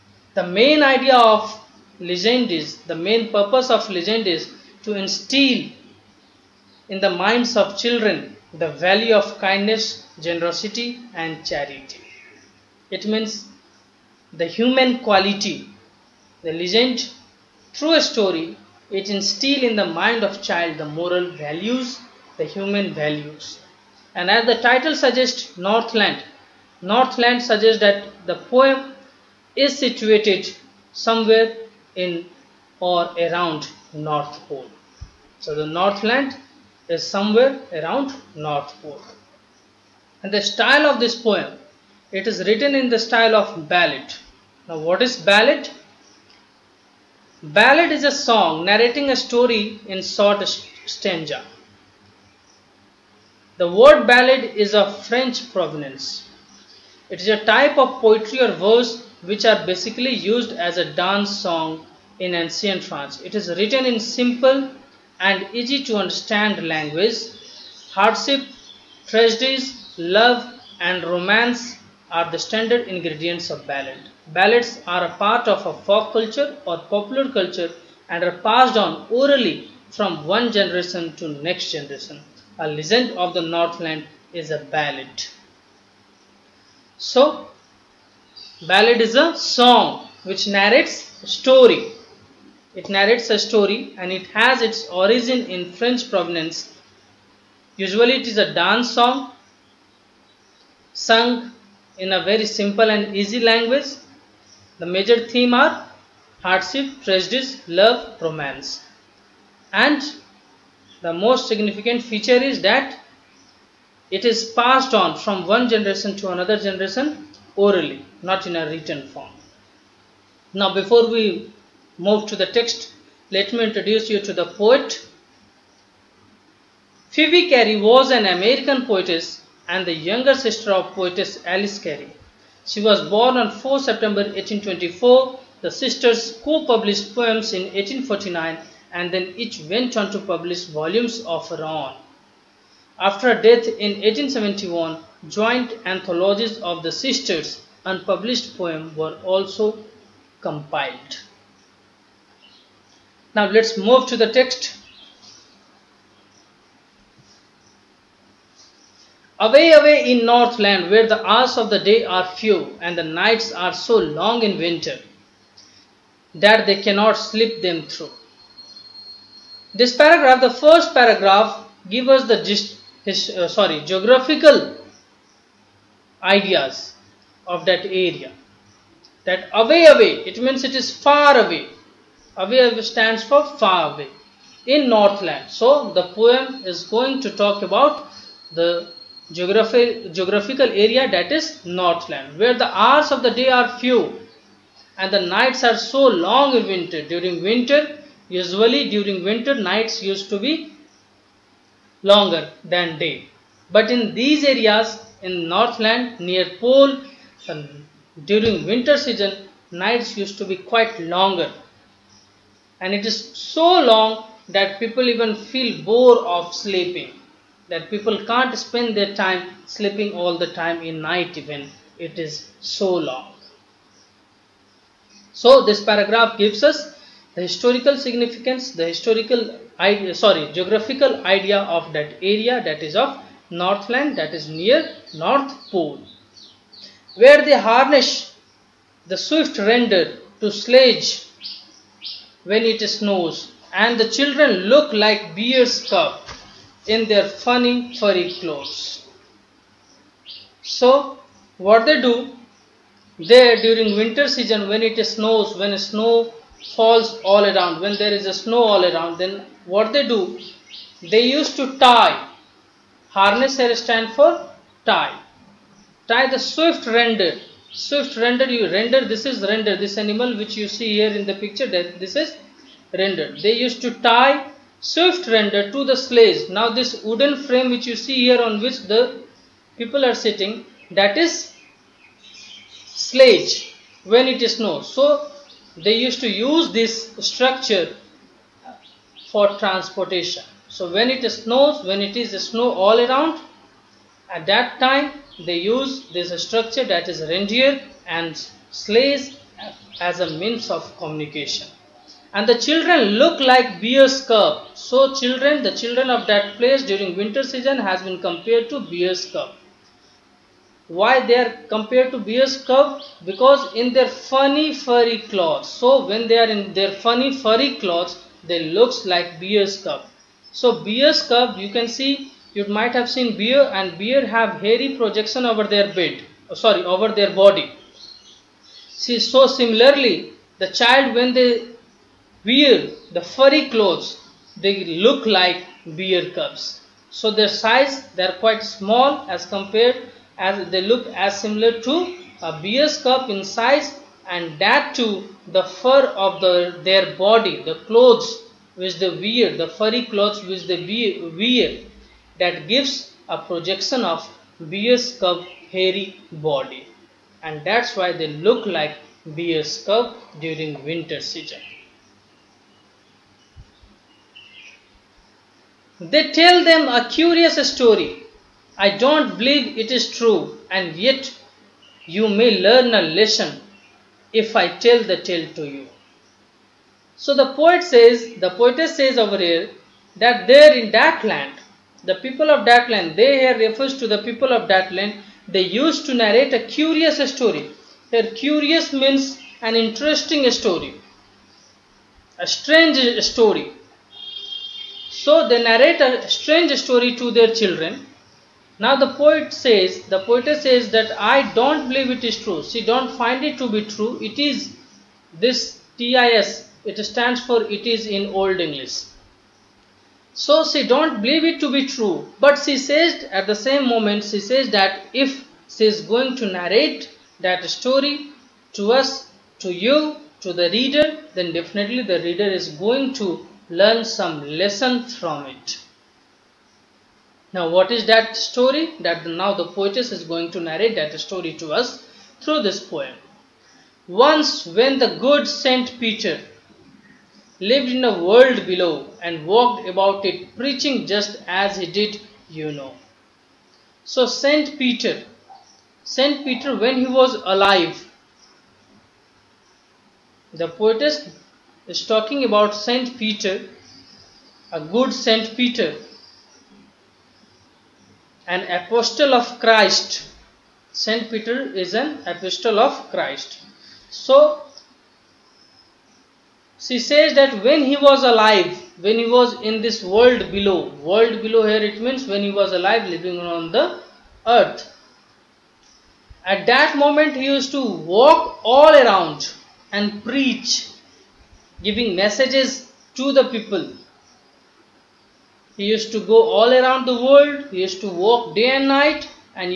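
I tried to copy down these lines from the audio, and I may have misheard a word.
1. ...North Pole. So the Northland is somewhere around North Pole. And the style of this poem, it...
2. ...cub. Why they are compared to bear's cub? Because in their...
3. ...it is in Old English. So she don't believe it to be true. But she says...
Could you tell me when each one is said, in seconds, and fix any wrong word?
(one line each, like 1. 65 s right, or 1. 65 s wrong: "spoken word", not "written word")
1. 33 s right
2. 309 s right
3. 407 s right.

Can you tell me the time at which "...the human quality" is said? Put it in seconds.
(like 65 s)
14 s.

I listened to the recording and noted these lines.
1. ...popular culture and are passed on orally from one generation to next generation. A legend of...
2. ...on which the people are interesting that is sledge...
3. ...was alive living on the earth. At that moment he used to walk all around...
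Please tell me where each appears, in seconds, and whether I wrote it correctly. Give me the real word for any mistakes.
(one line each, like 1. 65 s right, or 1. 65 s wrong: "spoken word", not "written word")
1. 76 s right
2. 278 s wrong: "sitting", not "interesting"
3. 472 s right.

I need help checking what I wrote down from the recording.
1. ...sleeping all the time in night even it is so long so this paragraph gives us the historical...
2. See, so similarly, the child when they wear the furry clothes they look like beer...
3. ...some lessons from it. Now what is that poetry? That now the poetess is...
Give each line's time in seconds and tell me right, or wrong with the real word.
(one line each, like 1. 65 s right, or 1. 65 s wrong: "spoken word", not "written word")
1. 219 s right
2. 328 s right
3. 424 s wrong: "story", not "poetry".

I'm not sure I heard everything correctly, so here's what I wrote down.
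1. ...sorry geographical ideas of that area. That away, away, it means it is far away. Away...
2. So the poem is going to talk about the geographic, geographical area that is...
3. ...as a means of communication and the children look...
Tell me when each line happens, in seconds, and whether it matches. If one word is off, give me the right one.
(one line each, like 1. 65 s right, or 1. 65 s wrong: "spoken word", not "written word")
1. 173 s right
2. 185 s right
3. 299 s right.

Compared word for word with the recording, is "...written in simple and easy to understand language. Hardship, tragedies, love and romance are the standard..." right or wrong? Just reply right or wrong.
right.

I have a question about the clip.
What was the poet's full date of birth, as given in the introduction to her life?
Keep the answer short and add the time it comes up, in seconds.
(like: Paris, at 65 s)
4 September 1824, at 133 s.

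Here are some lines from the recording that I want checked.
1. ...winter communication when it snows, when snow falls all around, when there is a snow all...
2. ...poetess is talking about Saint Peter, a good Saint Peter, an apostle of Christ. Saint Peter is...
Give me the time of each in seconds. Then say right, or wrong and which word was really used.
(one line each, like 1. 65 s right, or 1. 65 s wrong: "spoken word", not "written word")
1. 253 s wrong: "season", not "communication"
2. 450 s right.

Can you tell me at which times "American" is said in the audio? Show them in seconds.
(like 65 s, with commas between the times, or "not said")
128 s.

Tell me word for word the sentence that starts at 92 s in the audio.
It narrates a story and it has its origin in French provenance.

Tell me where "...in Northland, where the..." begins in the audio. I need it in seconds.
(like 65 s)
160 s.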